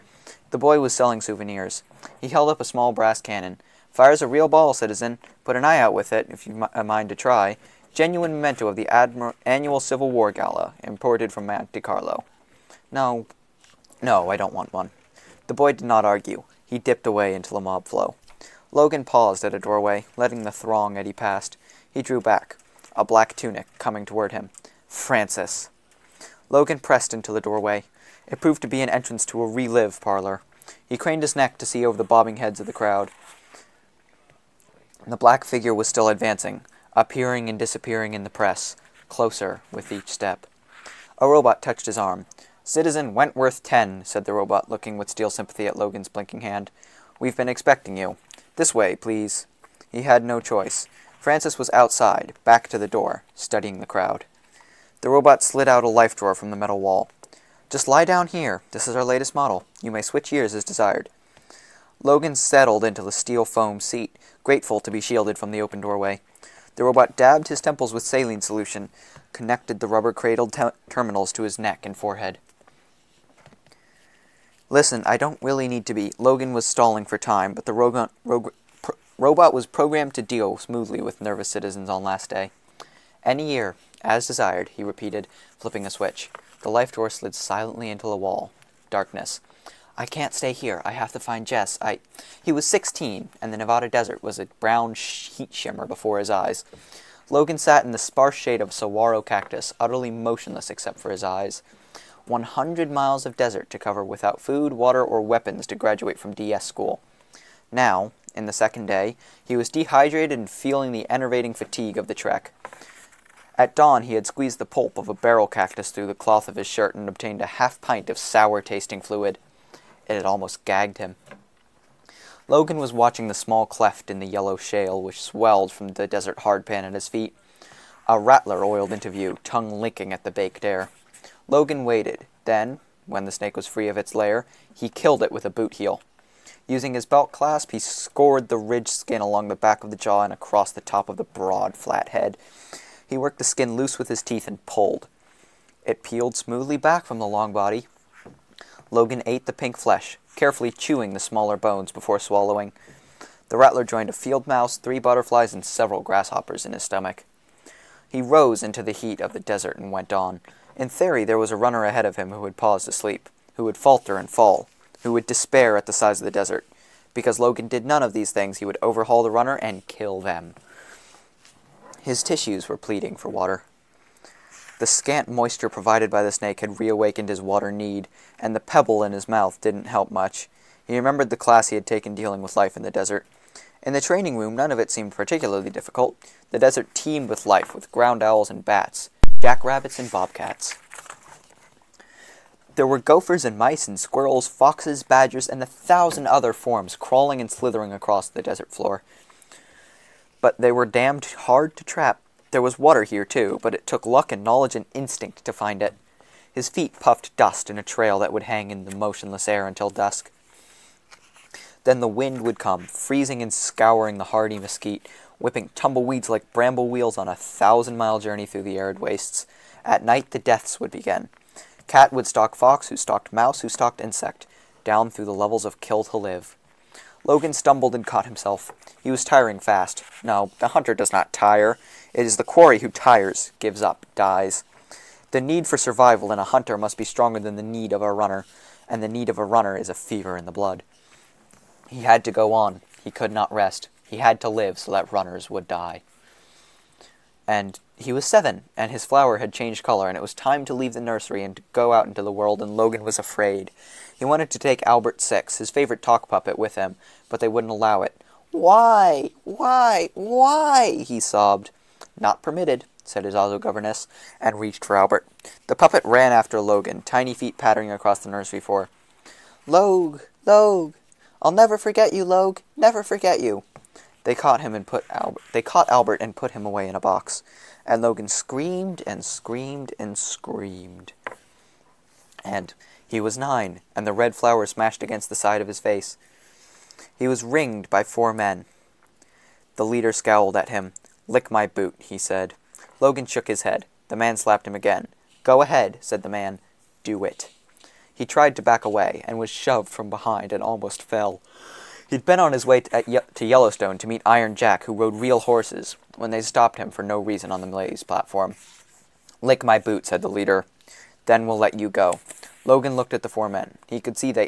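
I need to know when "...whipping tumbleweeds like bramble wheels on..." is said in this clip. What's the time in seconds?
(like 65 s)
215 s.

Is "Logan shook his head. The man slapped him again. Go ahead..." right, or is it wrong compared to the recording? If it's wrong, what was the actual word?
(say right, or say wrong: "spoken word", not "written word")
right.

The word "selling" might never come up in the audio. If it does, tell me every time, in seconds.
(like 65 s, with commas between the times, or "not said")
0 s.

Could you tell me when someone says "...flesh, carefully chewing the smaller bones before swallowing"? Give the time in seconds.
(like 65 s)
149 s.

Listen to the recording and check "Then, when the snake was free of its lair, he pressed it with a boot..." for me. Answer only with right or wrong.
wrong.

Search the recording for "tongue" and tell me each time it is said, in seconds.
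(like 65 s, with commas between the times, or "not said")
129 s.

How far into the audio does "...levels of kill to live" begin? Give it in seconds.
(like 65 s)
225 s.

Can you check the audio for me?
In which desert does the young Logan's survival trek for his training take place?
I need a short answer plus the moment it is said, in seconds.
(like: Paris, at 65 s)
Nevada, at 93 s.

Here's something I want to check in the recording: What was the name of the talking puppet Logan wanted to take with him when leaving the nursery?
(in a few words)
Albert Six.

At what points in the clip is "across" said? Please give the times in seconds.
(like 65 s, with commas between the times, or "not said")
140 s, 197 s, 267 s.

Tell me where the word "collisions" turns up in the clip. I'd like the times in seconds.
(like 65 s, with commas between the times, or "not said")
not said.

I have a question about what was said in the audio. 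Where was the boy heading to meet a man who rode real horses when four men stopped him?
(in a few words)
Yellowstone.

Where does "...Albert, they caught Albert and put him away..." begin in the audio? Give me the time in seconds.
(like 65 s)
275 s.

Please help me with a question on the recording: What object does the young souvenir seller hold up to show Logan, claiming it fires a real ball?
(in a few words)
small brass cannon.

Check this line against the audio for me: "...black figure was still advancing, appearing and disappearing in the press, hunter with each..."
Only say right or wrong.
wrong.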